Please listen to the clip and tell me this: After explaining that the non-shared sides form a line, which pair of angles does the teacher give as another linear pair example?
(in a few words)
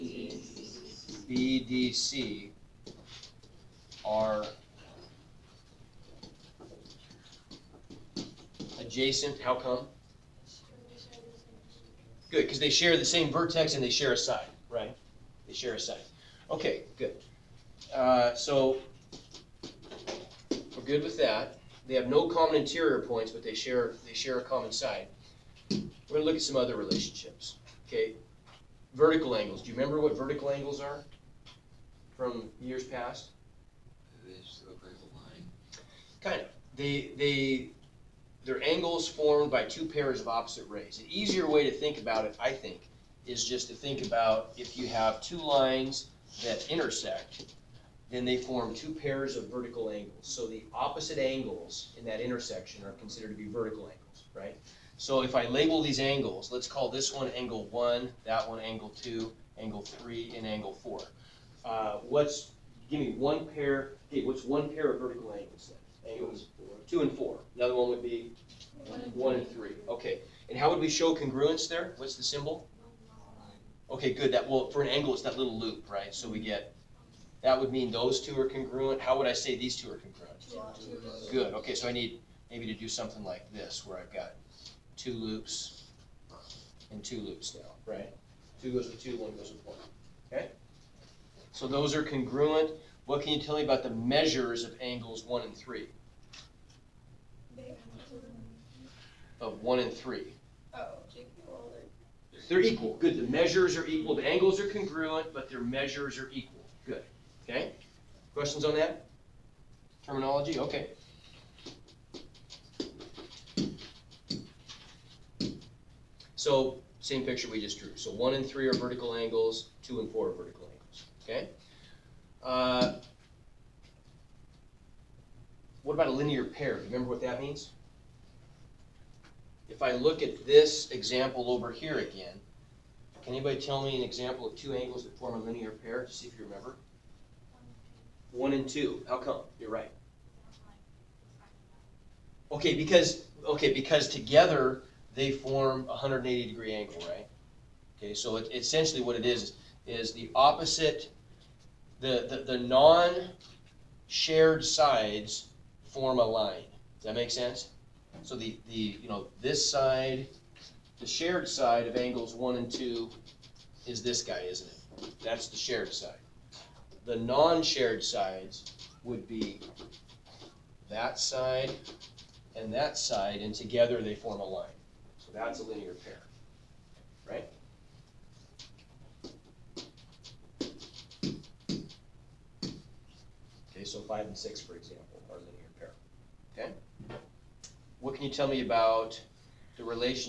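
5 and 6.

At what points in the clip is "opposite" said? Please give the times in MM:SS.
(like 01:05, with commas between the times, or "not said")
00:40, 00:50, 02:30.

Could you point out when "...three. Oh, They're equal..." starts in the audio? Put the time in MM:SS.
01:39.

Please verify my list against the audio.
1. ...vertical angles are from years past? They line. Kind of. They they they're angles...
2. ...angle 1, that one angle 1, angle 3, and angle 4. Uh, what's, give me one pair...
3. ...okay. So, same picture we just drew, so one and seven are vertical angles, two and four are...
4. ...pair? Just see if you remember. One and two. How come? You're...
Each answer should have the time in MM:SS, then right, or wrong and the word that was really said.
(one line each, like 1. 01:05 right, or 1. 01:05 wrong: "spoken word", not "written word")
1. 00:30 right
2. 00:57 wrong: "2", not "1"
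3. 01:50 wrong: "three", not "seven"
4. 02:15 right.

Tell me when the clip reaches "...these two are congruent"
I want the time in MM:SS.
01:19.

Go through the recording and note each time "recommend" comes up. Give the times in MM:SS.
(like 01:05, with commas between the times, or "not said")
not said.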